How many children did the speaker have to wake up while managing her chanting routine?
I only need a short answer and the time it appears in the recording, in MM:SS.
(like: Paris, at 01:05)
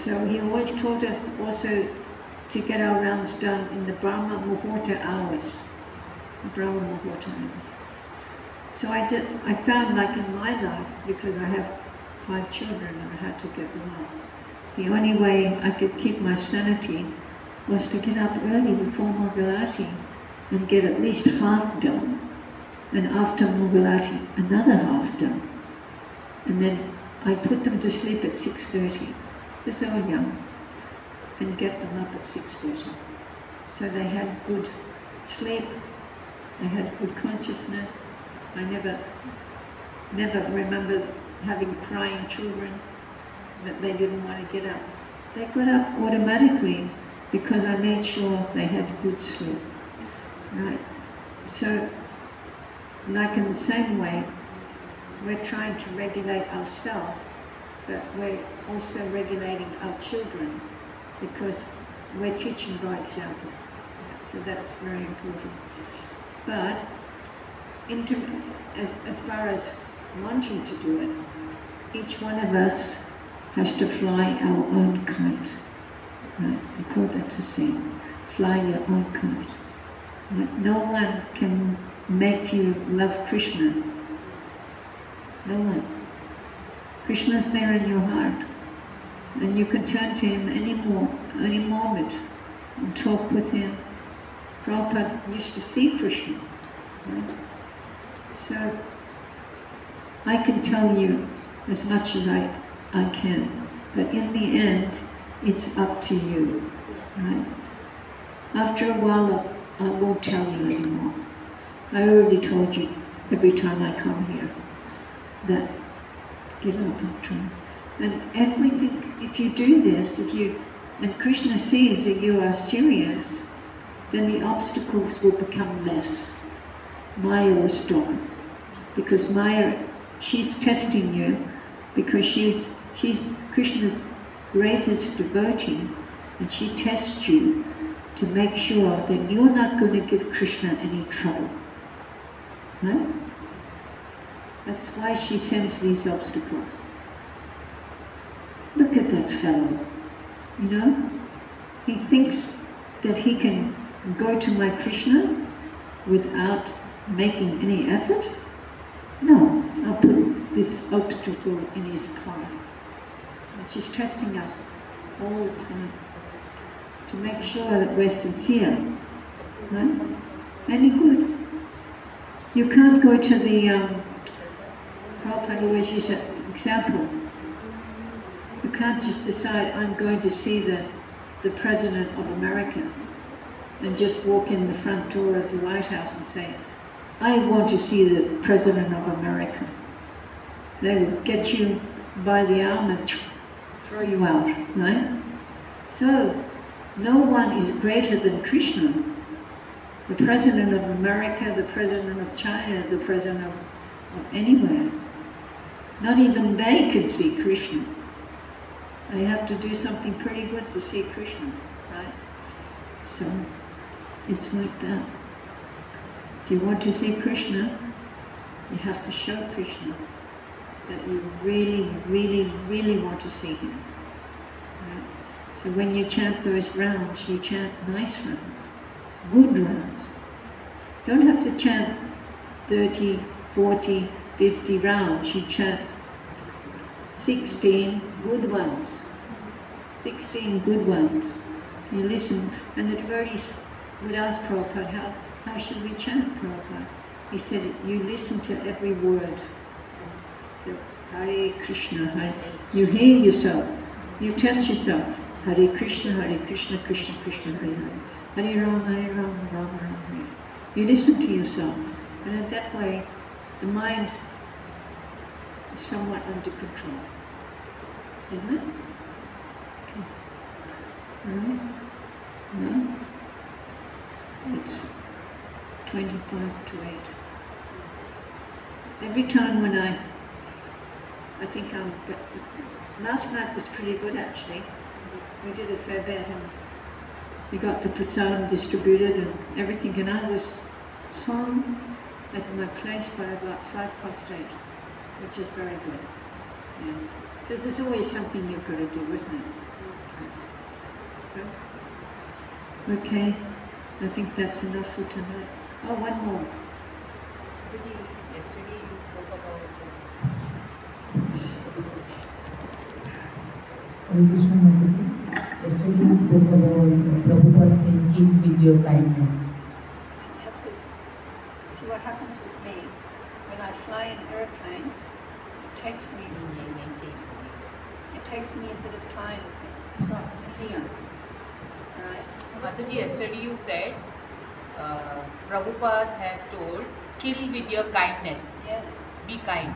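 5, at 00:12.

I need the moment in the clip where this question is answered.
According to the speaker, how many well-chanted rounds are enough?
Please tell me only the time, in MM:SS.
03:57.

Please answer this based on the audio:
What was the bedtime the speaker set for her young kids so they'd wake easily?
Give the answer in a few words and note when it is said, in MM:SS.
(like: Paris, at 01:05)
6:30, at 00:28.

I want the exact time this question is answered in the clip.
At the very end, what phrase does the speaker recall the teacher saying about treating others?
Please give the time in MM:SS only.
05:37.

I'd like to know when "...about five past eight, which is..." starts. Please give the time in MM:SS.
04:53.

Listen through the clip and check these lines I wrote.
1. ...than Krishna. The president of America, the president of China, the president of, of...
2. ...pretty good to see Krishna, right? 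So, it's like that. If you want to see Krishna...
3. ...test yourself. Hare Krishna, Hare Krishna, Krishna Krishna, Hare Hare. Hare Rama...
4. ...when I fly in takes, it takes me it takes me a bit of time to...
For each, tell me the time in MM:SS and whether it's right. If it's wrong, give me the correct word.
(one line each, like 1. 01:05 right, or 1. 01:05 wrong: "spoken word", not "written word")
1. 03:18 right
2. 03:30 right
3. 04:14 right
4. 05:23 wrong: "airplanes", not "takes".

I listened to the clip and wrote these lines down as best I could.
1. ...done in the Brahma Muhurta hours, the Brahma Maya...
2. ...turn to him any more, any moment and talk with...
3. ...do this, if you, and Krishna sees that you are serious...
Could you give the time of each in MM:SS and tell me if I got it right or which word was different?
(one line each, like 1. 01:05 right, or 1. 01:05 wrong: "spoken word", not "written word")
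1. 00:03 wrong: "Muhurta", not "Maya"
2. 01:29 right
3. 01:59 right.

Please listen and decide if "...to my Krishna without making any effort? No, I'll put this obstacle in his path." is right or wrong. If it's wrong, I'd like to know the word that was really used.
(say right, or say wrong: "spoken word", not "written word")
right.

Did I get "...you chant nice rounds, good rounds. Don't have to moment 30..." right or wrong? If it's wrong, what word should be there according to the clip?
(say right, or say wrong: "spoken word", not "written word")
wrong: "chant", not "moment".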